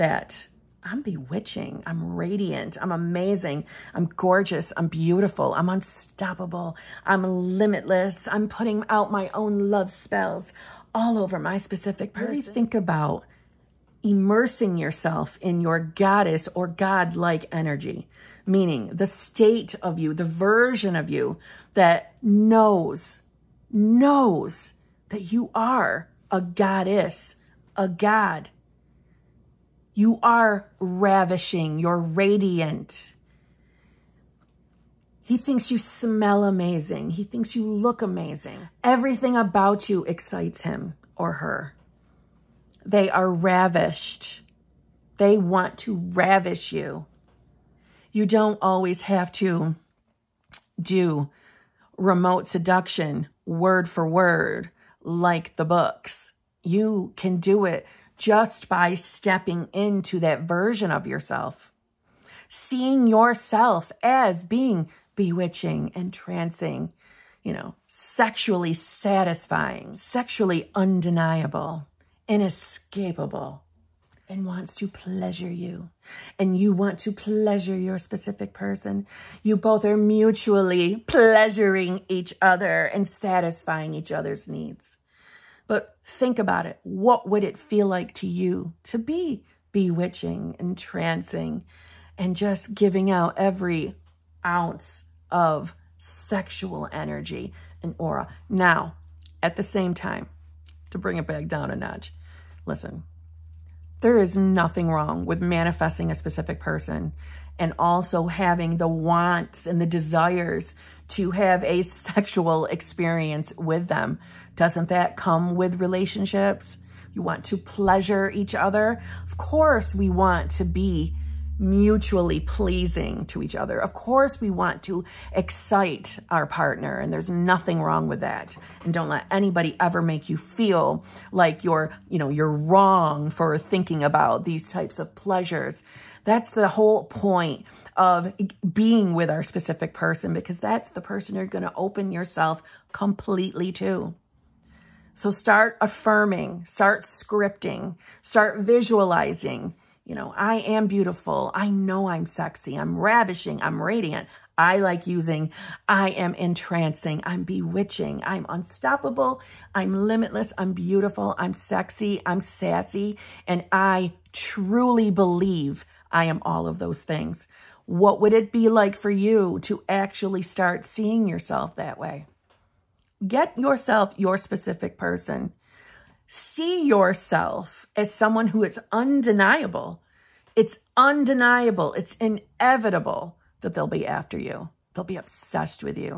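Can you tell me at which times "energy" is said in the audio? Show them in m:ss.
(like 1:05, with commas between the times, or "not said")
0:17, 1:36.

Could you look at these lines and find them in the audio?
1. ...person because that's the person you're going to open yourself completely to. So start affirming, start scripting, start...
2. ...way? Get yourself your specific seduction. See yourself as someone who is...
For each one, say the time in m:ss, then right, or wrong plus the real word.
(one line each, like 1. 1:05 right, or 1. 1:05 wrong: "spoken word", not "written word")
1. 2:19 right
2. 2:51 wrong: "person", not "seduction".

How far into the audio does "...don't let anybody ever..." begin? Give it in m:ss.
2:08.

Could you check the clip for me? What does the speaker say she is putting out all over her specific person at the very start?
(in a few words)
love spells.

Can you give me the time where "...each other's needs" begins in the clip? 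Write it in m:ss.
1:23.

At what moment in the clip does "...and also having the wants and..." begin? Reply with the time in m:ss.
1:47.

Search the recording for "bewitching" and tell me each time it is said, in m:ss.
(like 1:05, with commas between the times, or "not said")
0:01, 1:05, 1:29, 2:37.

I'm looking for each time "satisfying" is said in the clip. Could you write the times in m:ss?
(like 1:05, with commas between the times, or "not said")
1:08, 1:23.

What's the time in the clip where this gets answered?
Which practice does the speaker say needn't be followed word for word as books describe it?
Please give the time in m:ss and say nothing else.
0:51.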